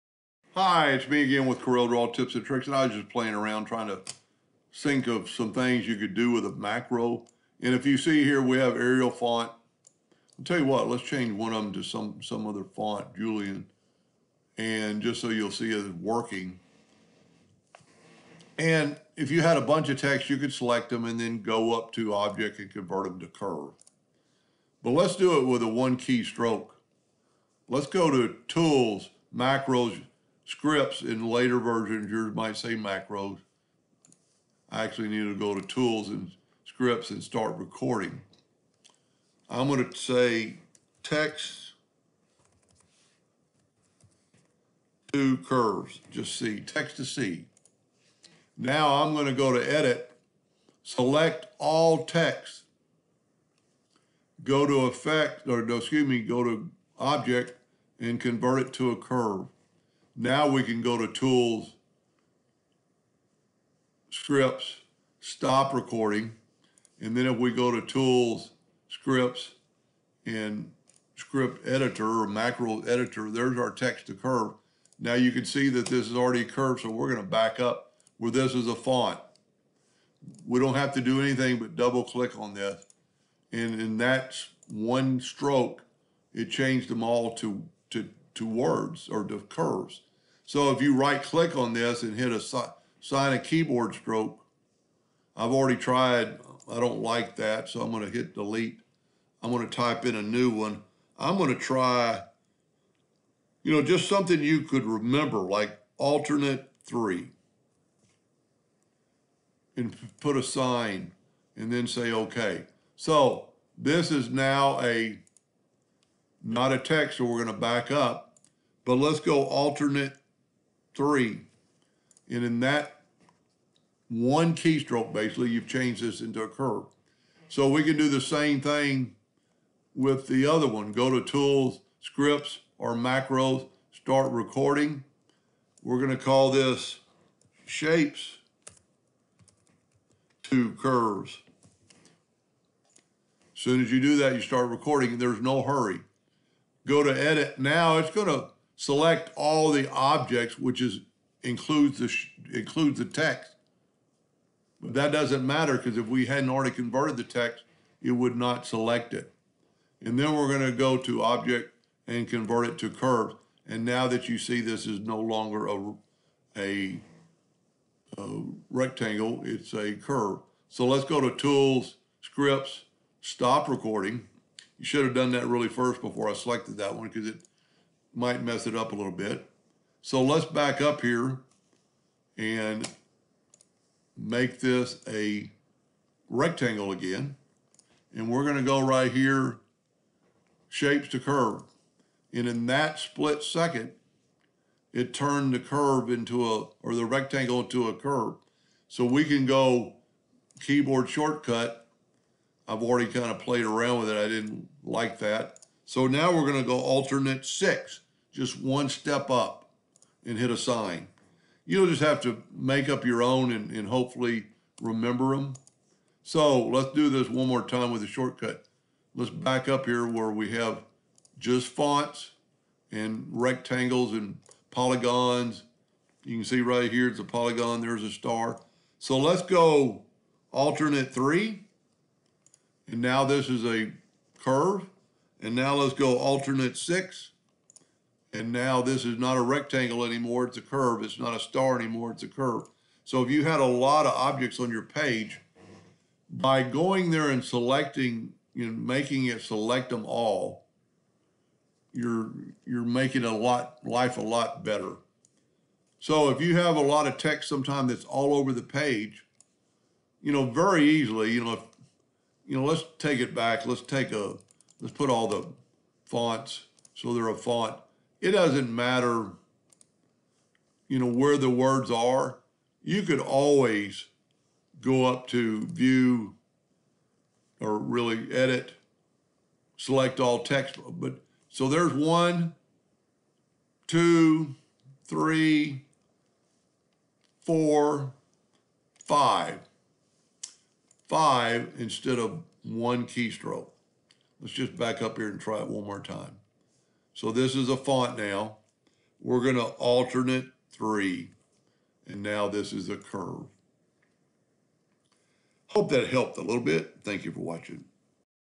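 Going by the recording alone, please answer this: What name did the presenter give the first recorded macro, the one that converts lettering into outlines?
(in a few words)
text to curves.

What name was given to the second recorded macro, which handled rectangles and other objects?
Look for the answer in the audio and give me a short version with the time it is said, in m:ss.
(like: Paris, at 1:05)
Shapes to Curves, at 2:17.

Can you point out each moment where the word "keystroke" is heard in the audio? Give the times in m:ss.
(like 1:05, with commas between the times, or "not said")
2:04, 4:53.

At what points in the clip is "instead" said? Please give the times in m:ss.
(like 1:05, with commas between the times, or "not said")
4:51.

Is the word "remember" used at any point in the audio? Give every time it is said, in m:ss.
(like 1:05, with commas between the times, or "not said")
1:44, 3:34.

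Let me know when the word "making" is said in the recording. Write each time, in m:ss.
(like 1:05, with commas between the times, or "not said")
4:08, 4:12.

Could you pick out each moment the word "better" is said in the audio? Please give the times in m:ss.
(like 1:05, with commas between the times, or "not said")
4:14.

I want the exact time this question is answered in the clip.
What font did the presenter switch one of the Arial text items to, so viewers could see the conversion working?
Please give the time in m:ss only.
0:13.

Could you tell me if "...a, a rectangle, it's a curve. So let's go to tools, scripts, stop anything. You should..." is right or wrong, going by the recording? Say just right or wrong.
wrong.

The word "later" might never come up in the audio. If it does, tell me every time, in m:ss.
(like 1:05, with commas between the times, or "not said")
0:31.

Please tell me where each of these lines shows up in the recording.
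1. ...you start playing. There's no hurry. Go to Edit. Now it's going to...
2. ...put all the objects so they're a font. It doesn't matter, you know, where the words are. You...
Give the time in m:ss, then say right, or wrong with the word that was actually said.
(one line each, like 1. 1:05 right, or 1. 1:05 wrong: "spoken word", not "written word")
1. 2:24 wrong: "recording", not "playing"
2. 4:24 wrong: "fonts", not "objects".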